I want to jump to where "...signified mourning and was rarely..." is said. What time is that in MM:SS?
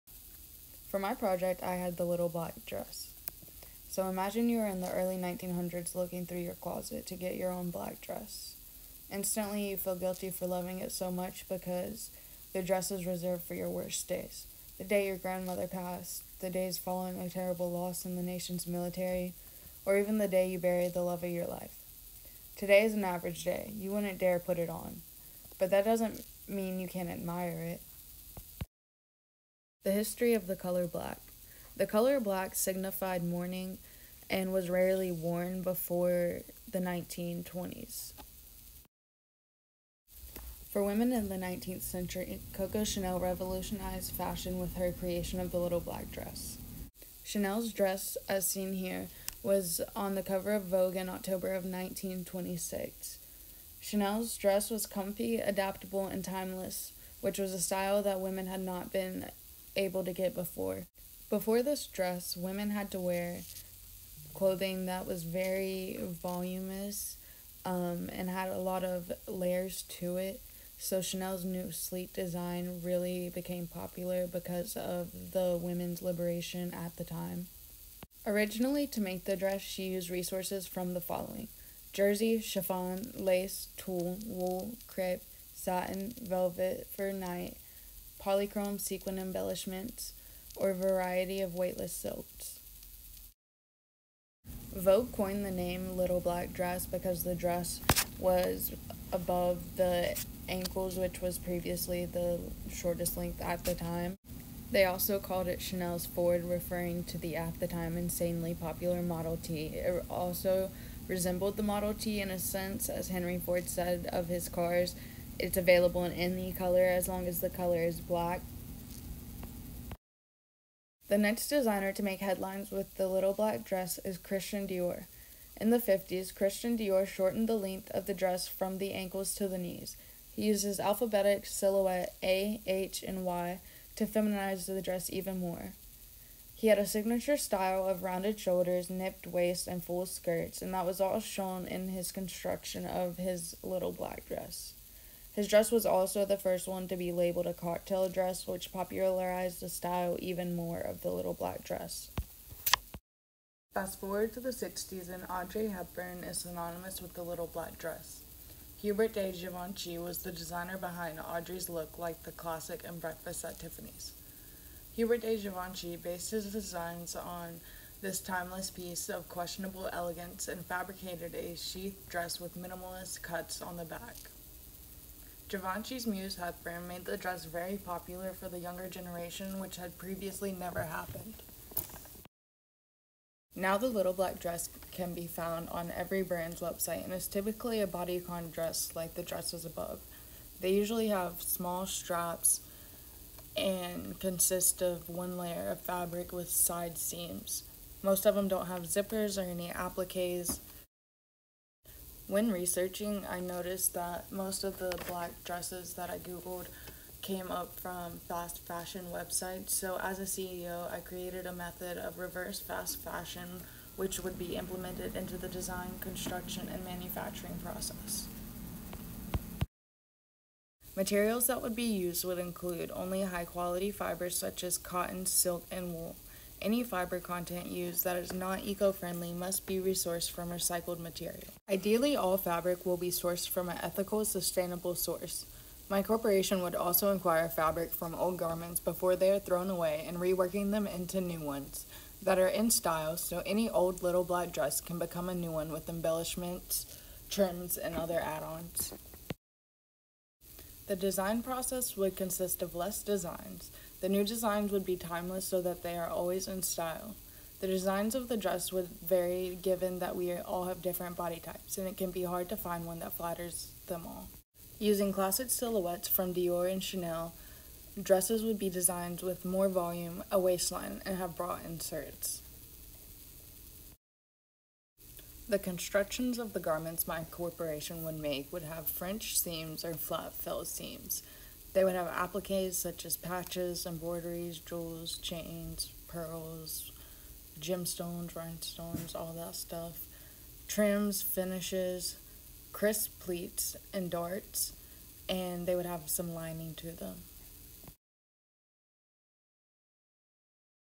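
00:32.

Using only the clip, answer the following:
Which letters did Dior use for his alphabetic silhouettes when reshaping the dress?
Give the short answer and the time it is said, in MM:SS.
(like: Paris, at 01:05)
A, H, and Y, at 02:12.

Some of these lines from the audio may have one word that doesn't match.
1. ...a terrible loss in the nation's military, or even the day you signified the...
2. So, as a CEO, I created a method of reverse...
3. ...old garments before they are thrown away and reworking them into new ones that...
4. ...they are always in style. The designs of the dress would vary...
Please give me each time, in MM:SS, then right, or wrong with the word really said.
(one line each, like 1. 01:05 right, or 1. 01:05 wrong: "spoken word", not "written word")
1. 00:17 wrong: "buried", not "signified"
2. 03:29 right
3. 03:58 right
4. 04:15 right.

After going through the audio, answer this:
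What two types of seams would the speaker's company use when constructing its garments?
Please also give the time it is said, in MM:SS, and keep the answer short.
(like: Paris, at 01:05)
French seams or flat fell seams, at 04:38.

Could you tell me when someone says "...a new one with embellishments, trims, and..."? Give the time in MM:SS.
04:05.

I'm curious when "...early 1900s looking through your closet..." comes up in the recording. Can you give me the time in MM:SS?
00:04.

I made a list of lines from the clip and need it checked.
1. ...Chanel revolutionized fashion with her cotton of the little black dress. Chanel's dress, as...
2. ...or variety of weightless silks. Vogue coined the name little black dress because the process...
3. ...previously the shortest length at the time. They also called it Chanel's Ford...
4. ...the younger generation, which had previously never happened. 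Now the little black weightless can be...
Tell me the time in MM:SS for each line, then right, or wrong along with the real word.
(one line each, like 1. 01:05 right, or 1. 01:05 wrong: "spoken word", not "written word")
1. 00:42 wrong: "creation", not "cotton"
2. 01:30 wrong: "dress", not "process"
3. 01:41 right
4. 02:58 wrong: "dress", not "weightless".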